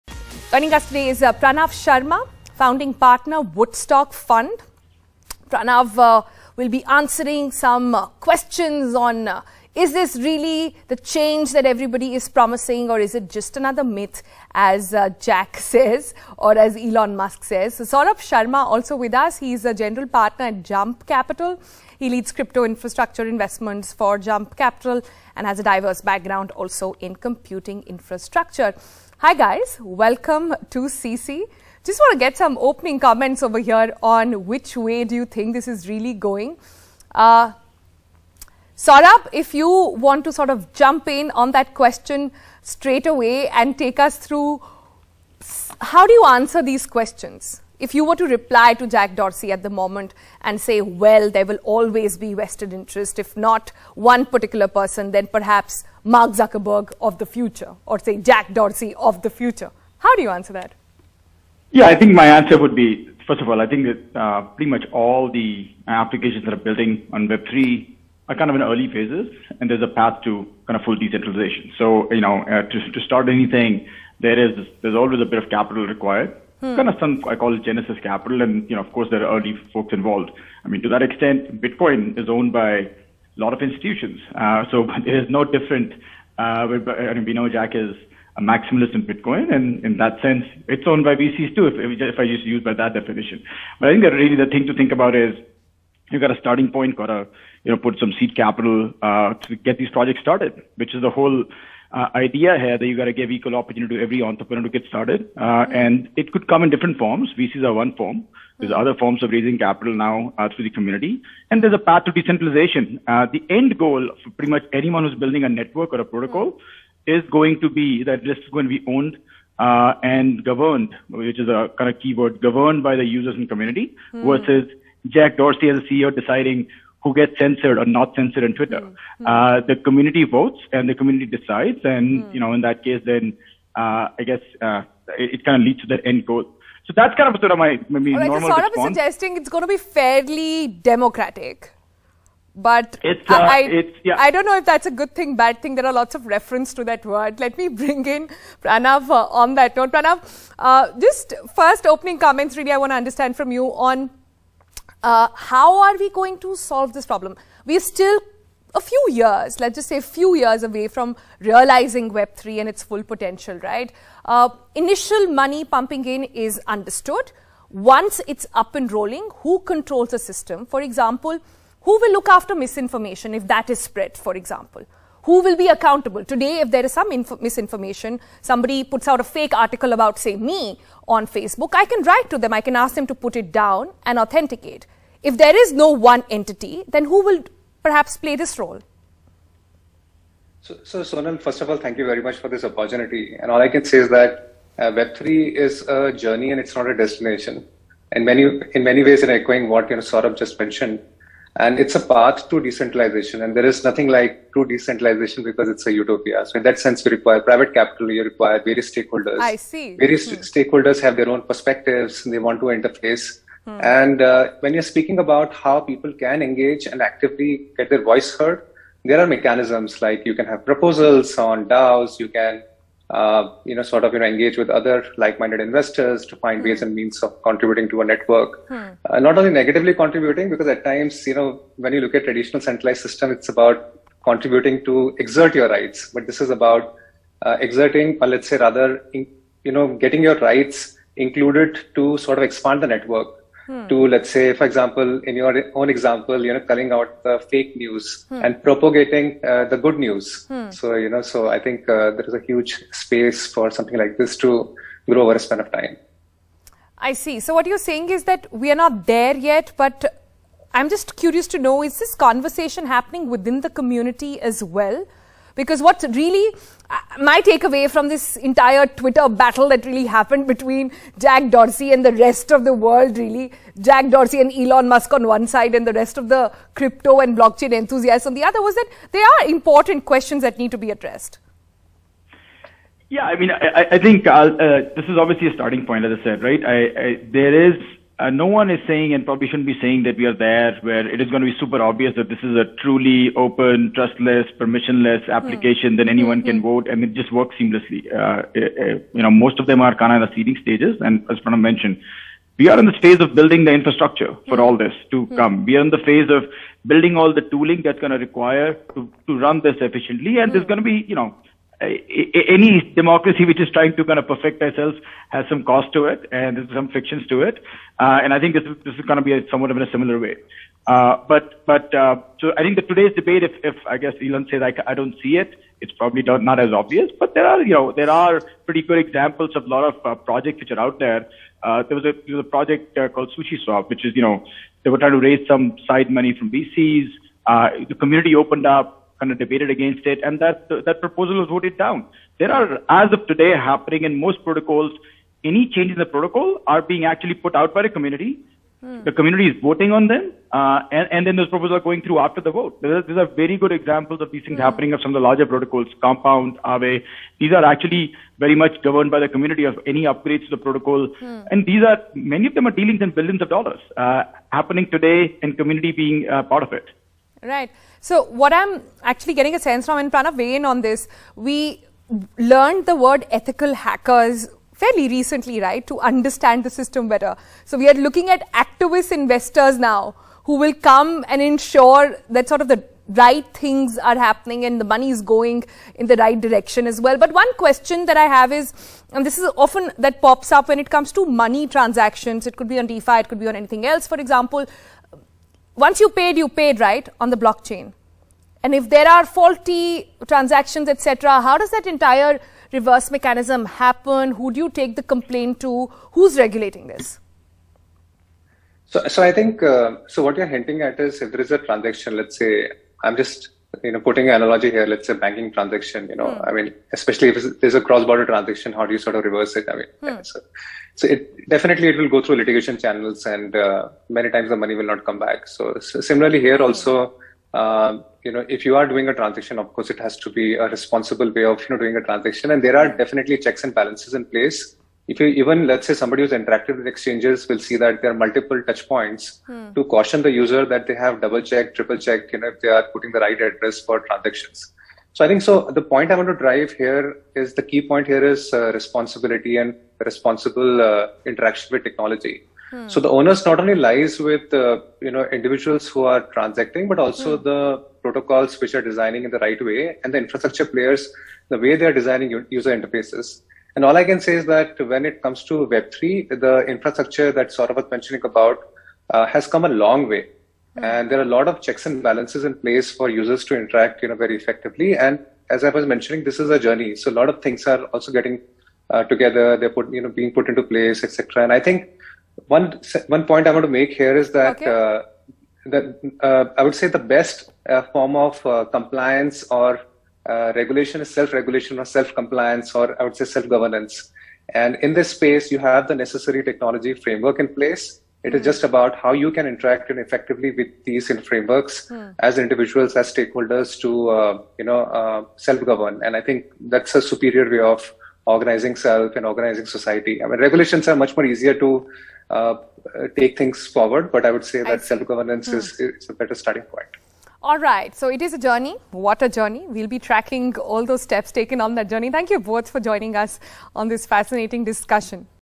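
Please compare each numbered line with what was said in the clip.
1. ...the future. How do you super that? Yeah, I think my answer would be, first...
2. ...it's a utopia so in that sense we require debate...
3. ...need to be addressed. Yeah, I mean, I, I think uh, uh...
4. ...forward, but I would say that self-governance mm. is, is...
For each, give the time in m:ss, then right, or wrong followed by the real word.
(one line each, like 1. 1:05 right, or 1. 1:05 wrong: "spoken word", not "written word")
1. 0:59 wrong: "answer", not "super"
2. 3:25 wrong: "private", not "debate"
3. 4:40 right
4. 8:33 right.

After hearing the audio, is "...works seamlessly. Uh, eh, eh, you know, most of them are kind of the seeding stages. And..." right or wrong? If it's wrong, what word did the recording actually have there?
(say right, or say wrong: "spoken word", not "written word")
right.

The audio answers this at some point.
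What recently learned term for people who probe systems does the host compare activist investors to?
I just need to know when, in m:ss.
6:13.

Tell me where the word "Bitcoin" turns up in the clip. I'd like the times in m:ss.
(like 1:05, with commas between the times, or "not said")
1:21, 1:29.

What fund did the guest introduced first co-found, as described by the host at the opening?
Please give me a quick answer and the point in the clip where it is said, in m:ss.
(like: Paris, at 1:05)
Woodstock Fund, at 0:03.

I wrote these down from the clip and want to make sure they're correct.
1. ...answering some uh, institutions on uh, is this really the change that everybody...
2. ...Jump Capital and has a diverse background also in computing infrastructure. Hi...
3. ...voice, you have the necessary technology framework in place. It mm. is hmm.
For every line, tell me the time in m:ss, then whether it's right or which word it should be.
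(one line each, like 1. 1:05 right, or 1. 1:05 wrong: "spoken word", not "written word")
1. 0:06 wrong: "questions", not "institutions"
2. 0:24 right
3. 8:15 wrong: "space", not "voice".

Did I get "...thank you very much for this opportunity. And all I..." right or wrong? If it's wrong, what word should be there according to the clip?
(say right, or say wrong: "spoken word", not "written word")
right.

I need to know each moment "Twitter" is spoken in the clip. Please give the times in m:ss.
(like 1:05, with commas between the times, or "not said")
2:08, 4:28.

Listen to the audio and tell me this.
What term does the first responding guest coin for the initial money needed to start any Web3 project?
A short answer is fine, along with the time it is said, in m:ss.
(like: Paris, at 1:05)
Genesis Capital, at 1:17.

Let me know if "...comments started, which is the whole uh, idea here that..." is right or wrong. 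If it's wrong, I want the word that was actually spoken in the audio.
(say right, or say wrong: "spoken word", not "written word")
wrong: "projects", not "comments".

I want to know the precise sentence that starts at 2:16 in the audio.
So that's kind of sort of my maybe right, normal so Saurabh response.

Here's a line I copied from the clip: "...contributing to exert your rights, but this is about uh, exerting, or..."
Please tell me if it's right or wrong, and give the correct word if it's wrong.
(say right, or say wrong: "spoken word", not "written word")
right.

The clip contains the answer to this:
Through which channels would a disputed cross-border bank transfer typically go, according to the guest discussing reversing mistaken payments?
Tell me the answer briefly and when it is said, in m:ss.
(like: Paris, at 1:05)
Litigation channels, at 7:02.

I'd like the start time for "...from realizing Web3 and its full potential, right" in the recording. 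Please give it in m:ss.
2:40.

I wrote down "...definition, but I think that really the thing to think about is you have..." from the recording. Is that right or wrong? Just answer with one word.
right.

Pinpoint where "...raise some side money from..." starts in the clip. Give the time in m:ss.
5:35.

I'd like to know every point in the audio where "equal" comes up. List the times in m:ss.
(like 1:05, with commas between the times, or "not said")
1:43.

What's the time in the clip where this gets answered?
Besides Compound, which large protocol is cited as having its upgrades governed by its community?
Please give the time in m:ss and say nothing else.
5:56.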